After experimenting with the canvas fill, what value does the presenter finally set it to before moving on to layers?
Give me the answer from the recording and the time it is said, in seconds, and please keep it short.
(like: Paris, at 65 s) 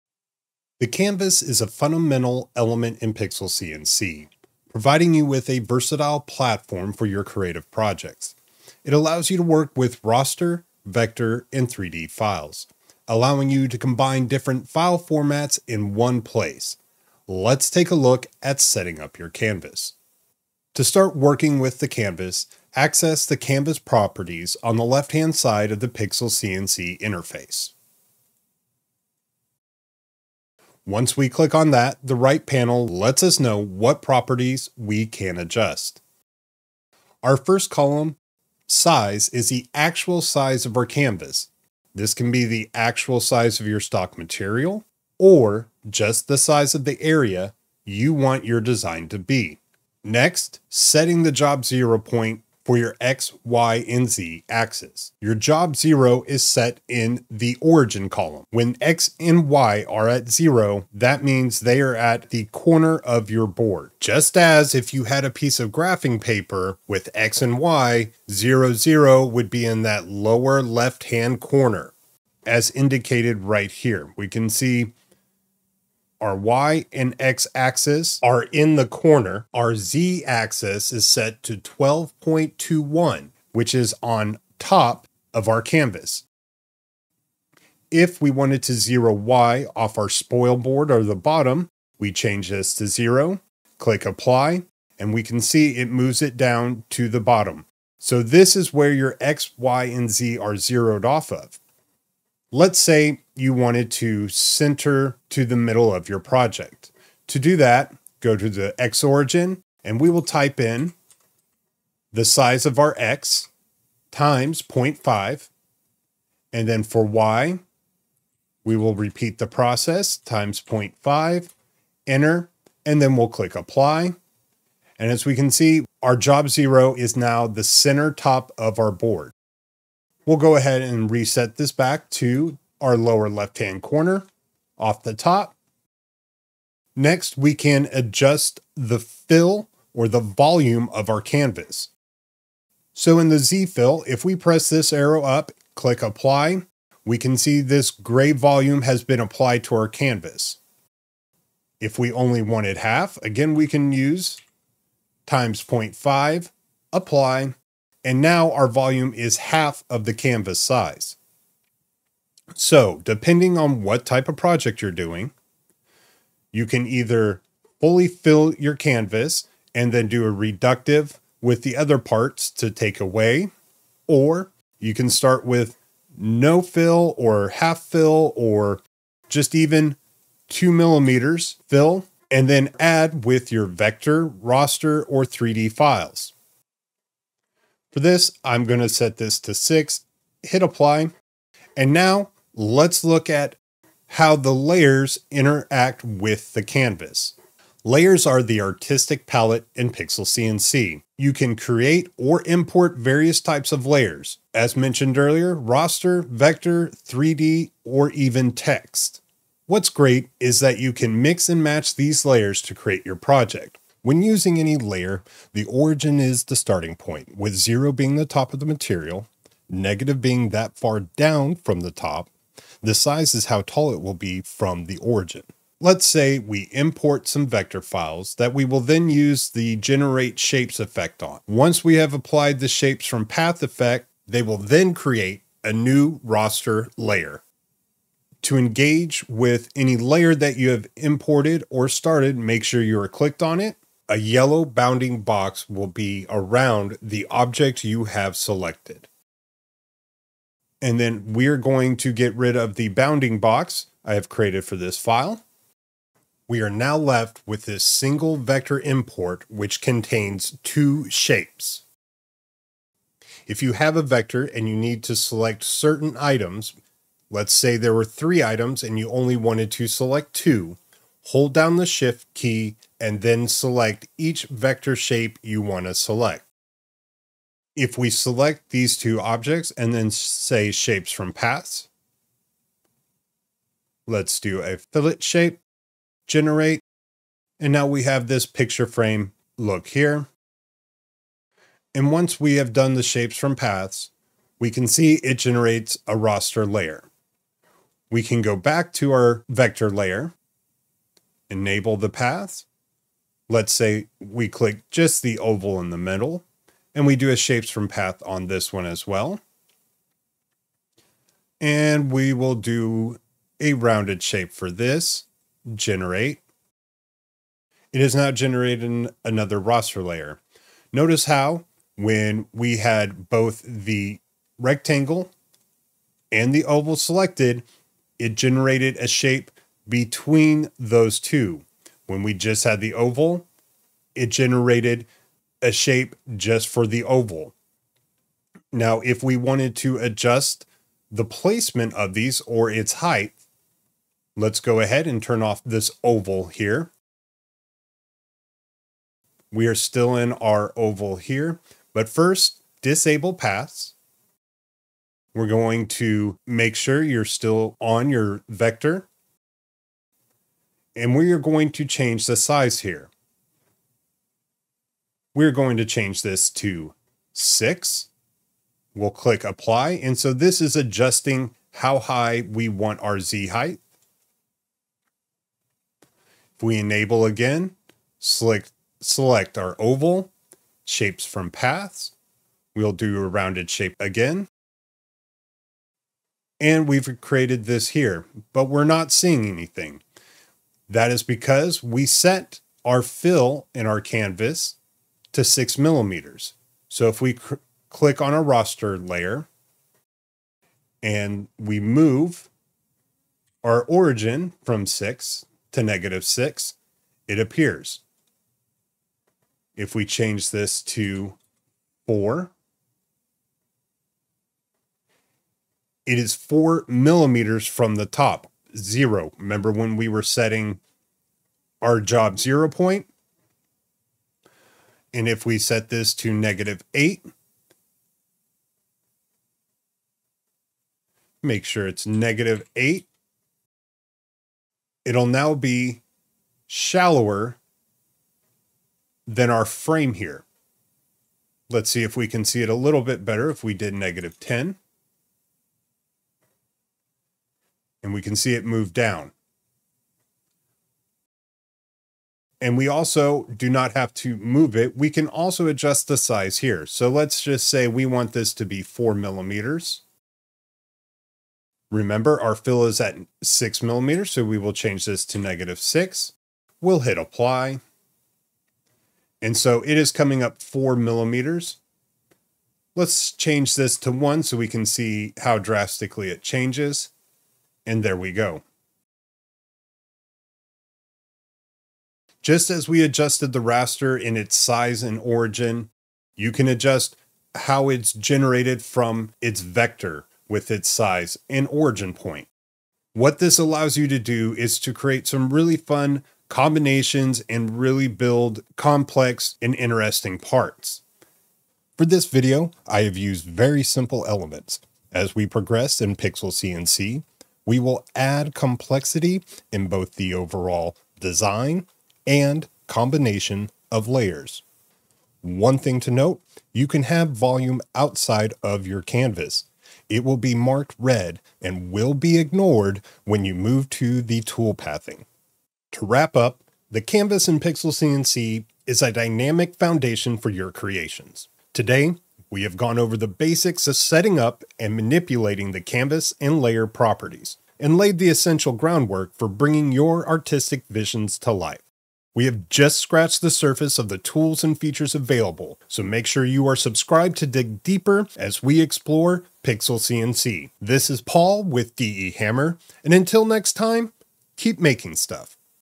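6, at 188 s.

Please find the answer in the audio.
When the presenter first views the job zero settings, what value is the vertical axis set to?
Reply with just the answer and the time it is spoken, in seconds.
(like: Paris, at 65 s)
12.21, at 81 s.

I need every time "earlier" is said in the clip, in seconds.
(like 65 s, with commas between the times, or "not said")
205 s.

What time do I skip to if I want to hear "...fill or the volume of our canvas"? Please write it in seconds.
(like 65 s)
138 s.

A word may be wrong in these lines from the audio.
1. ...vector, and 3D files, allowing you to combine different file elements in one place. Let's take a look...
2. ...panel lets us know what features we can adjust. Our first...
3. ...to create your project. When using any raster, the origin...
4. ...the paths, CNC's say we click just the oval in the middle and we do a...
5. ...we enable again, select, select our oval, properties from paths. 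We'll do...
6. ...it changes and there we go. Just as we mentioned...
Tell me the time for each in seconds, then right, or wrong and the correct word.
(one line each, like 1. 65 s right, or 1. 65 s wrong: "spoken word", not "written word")
1. 10 s wrong: "formats", not "elements"
2. 32 s wrong: "properties", not "features"
3. 212 s wrong: "layer", not "raster"
4. 301 s wrong: "Let", not "CNC"
5. 376 s wrong: "shapes", not "properties"
6. 476 s wrong: "adjusted", not "mentioned".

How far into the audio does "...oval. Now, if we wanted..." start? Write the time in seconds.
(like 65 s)
337 s.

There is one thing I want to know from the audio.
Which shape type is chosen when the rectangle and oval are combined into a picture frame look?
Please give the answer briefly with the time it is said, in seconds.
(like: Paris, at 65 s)
Fillet, at 284 s.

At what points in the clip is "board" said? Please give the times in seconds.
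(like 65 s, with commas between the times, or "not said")
63 s, 90 s, 128 s.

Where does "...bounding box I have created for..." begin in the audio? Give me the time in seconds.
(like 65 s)
252 s.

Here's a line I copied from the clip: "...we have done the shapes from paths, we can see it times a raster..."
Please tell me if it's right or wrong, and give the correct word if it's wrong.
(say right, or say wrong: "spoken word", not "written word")
wrong: "generates", not "times".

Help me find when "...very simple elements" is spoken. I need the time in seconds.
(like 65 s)
503 s.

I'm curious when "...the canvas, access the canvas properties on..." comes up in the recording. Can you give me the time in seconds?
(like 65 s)
21 s.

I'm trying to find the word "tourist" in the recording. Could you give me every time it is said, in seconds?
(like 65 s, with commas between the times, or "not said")
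not said.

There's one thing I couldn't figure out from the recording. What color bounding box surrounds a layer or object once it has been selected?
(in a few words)
Yellow.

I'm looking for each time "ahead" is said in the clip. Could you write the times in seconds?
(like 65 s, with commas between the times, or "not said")
130 s, 344 s.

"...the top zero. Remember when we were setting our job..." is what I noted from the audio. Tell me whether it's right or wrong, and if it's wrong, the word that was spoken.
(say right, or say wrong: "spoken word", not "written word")
right.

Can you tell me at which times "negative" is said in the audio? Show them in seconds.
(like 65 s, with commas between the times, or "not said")
219 s, 405 s, 426 s, 432 s, 443 s, 465 s.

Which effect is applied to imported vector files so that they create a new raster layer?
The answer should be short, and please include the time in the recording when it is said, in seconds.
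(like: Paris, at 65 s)
Generate shapes, at 229 s.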